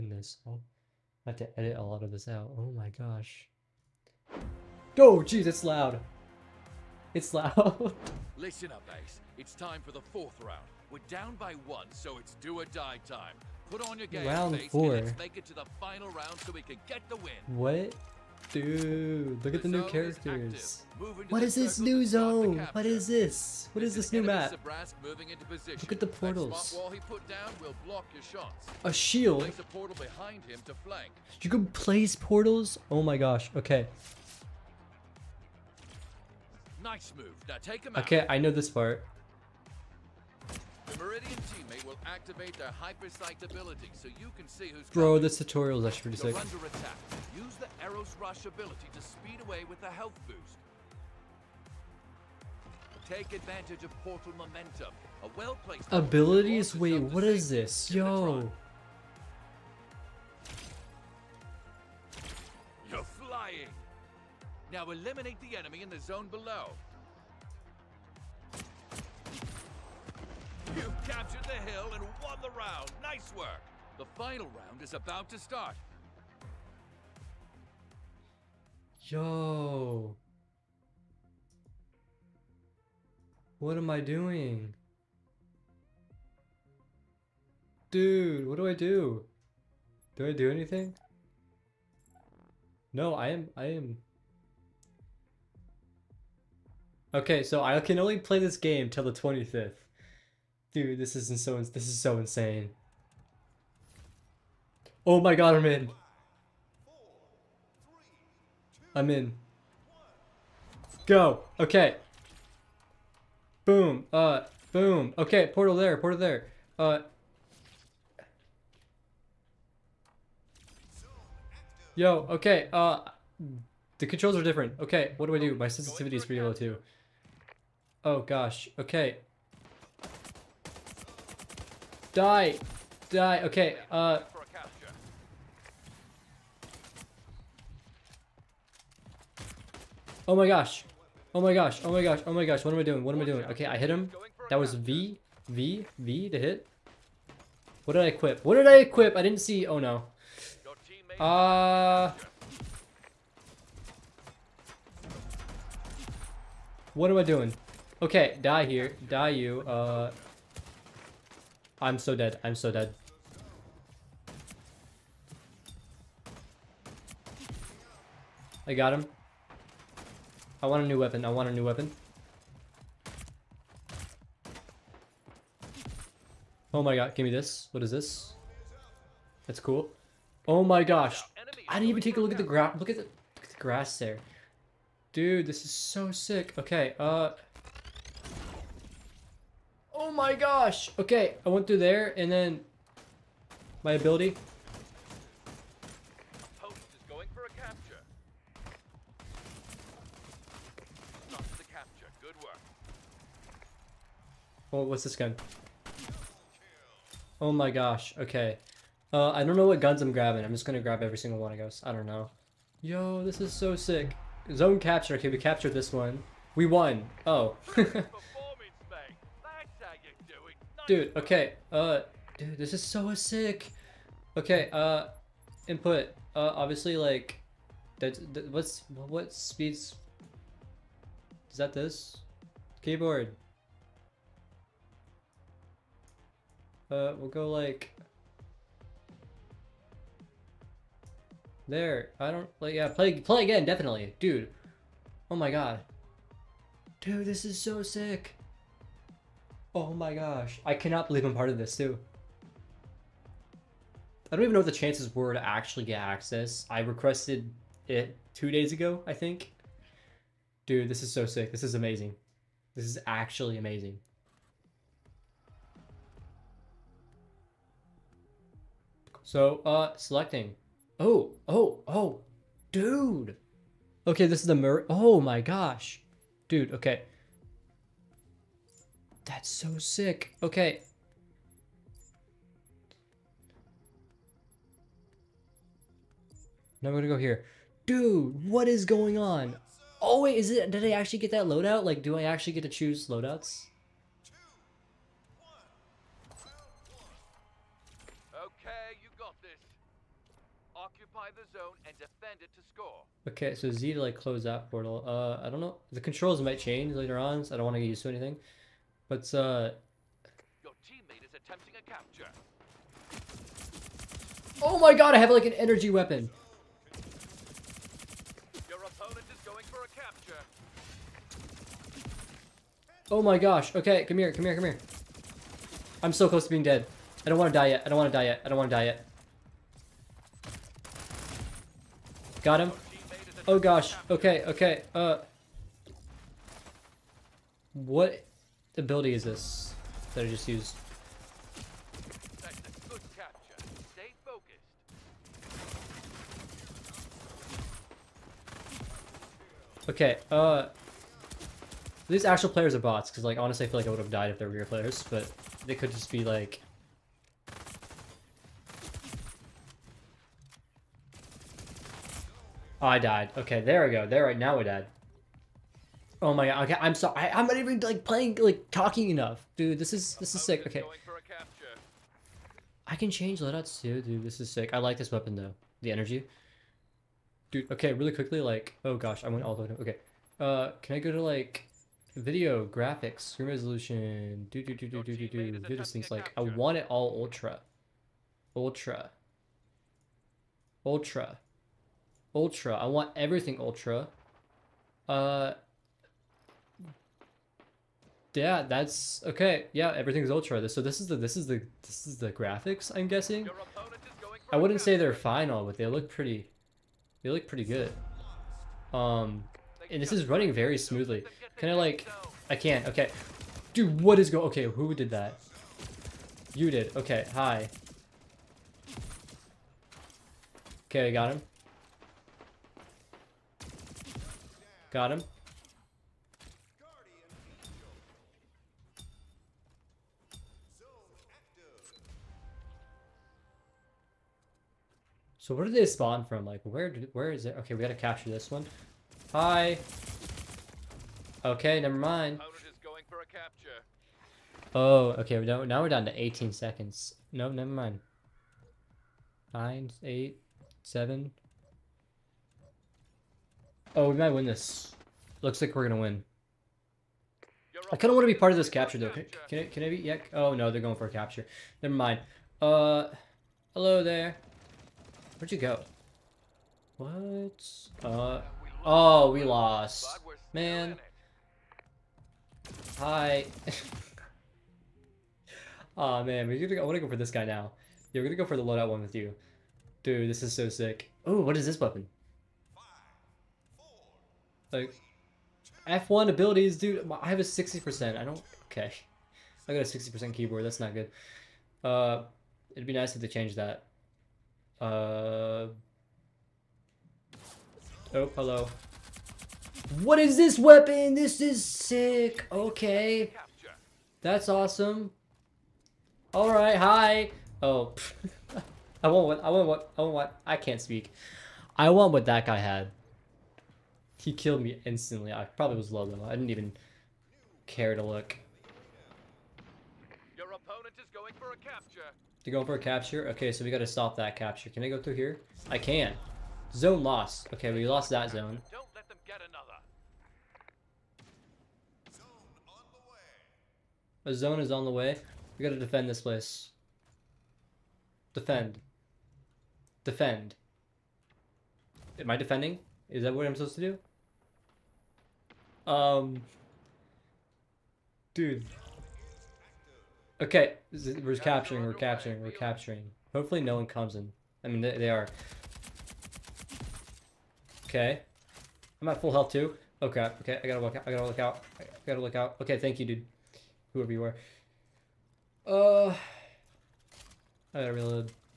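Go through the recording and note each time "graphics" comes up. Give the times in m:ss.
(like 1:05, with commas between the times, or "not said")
6:22, 6:42.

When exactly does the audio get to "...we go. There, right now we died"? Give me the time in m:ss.
6:03.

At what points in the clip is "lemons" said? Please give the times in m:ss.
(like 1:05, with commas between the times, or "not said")
not said.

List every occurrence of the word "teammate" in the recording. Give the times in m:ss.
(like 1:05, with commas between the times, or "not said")
0:41, 5:10.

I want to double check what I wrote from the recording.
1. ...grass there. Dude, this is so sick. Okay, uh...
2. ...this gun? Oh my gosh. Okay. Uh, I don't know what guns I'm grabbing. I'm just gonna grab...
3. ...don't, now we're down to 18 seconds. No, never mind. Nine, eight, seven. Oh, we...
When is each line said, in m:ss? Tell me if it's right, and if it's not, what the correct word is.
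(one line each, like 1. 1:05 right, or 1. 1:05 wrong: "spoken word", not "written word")
1. 3:03 right
2. 3:25 right
3. 7:25 right.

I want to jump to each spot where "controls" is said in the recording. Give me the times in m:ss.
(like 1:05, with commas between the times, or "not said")
2:04, 5:06.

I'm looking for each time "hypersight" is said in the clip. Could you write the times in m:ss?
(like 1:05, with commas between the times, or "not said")
0:42.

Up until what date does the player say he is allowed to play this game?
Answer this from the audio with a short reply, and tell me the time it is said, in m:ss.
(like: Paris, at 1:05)
The 25th, at 1:39.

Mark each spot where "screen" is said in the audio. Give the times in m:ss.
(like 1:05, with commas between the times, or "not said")
6:23.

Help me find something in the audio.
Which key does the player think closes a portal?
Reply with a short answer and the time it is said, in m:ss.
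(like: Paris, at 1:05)
Z, at 5:03.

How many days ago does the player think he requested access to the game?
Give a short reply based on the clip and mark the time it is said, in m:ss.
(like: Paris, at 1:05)
2 days, at 4:18.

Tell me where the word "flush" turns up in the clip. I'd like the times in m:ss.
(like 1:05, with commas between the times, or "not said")
not said.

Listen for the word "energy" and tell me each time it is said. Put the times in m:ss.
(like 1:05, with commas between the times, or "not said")
5:15, 6:15.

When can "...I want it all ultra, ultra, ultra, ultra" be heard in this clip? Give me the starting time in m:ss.
6:26.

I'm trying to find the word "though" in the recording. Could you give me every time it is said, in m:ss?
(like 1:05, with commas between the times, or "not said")
6:15, 7:38, 8:36.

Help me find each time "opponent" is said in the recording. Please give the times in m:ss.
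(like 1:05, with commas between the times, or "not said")
5:18, 8:40.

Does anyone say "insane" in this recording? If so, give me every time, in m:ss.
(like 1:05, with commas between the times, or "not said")
1:42.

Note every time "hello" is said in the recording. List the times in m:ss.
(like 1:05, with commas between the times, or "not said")
7:43, 8:18.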